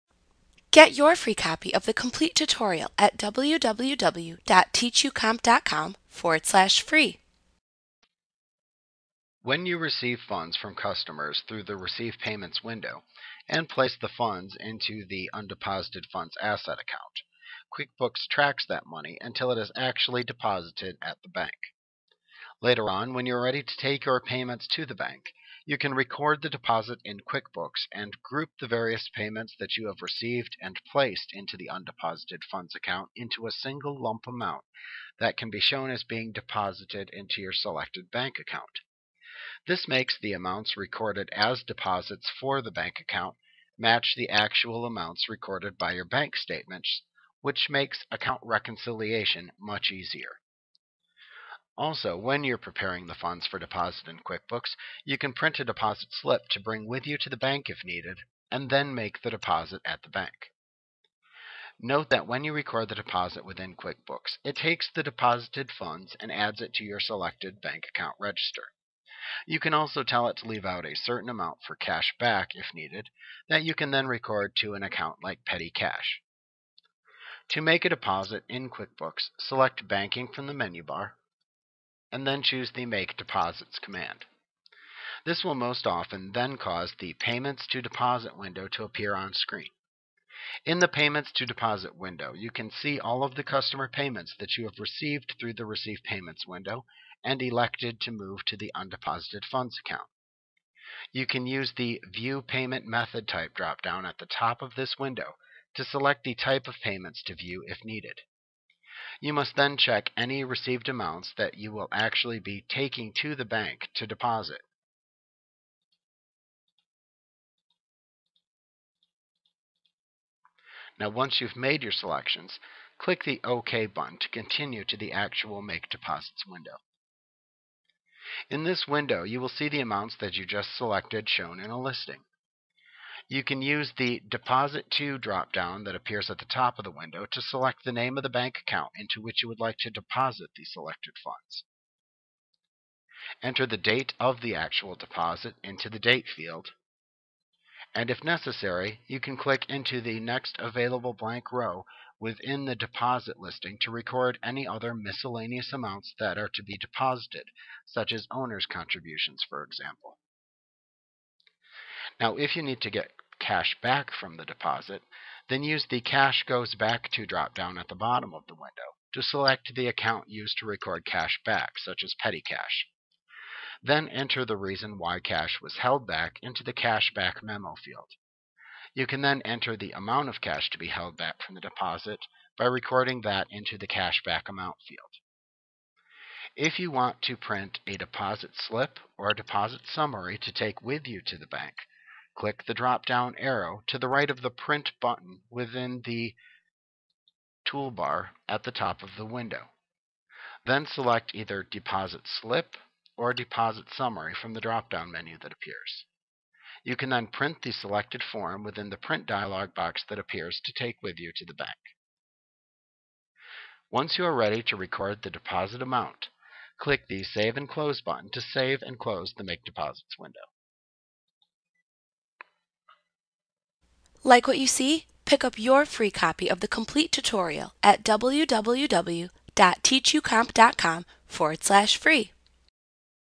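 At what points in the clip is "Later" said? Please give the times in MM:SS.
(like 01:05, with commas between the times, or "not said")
00:22.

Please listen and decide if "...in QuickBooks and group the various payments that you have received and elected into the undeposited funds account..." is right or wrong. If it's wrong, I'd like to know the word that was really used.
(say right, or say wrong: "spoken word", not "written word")
wrong: "placed", not "elected".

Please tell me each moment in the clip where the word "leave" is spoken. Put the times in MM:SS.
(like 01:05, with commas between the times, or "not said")
01:10.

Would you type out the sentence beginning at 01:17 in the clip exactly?
To make a deposit in QuickBooks, select Banking from the menu bar and then choose the Make Deposits command.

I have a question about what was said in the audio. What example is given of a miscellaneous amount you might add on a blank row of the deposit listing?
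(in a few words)
Owner's contributions.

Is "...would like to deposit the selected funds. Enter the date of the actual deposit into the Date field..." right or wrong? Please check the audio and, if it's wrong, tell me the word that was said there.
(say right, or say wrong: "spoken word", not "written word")
right.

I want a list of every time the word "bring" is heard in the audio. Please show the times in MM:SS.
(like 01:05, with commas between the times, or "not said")
00:56.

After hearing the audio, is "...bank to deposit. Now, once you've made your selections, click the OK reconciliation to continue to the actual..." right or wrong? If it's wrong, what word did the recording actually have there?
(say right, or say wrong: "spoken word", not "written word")
wrong: "button", not "reconciliation".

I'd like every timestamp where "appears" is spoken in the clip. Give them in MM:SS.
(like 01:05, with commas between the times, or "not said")
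01:28, 02:15, 03:25, 03:30.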